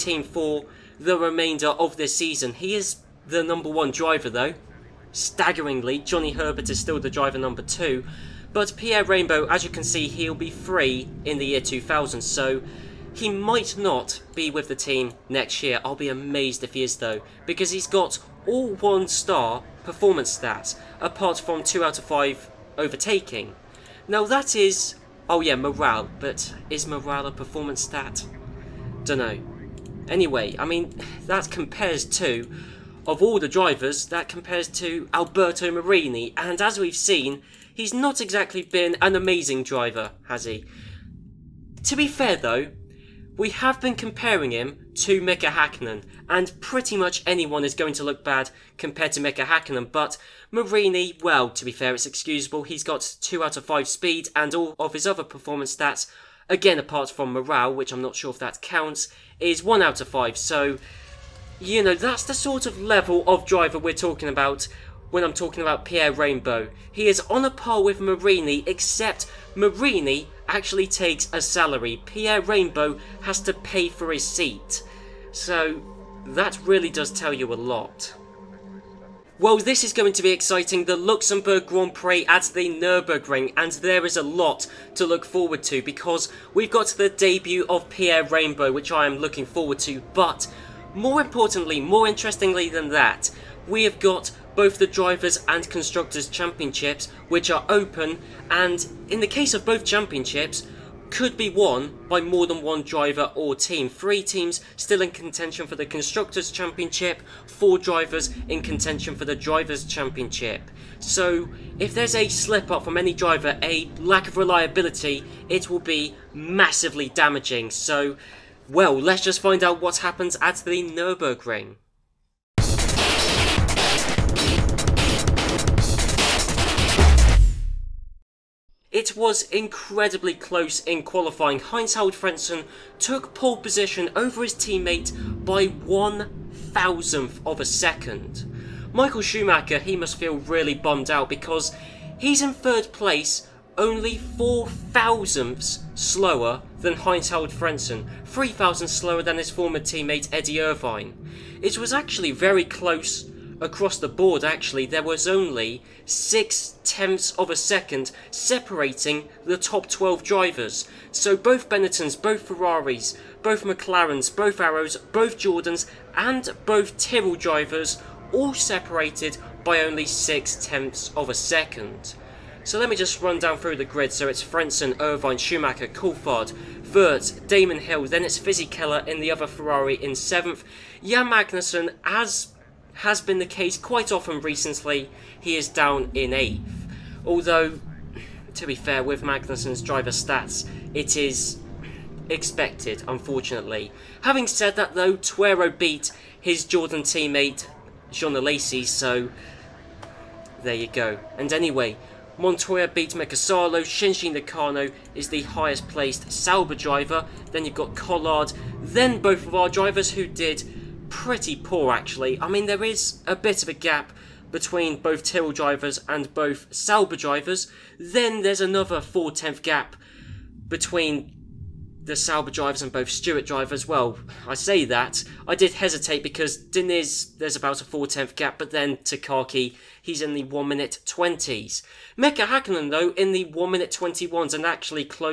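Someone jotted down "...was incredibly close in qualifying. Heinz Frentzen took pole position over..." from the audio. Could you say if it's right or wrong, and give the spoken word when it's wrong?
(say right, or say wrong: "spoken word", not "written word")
right.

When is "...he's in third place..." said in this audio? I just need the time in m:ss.
2:22.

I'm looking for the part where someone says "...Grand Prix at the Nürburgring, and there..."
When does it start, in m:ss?
1:21.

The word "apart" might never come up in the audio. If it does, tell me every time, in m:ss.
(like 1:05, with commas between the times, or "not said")
0:20, 0:56.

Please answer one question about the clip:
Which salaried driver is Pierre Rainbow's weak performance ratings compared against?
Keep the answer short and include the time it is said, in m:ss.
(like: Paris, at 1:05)
Alberto Marini, at 0:35.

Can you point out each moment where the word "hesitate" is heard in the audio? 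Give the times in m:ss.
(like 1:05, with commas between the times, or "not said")
3:45.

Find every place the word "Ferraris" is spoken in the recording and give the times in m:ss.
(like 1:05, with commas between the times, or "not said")
2:42, 2:59.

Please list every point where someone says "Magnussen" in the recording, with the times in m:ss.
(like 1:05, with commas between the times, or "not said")
3:01, 3:09.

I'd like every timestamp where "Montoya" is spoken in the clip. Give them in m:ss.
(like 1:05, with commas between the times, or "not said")
3:22.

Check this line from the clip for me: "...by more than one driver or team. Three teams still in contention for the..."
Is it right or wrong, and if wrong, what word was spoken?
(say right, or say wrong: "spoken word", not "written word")
right.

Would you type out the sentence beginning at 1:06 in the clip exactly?
He is on a par with Marini, except Marini actually takes a salary.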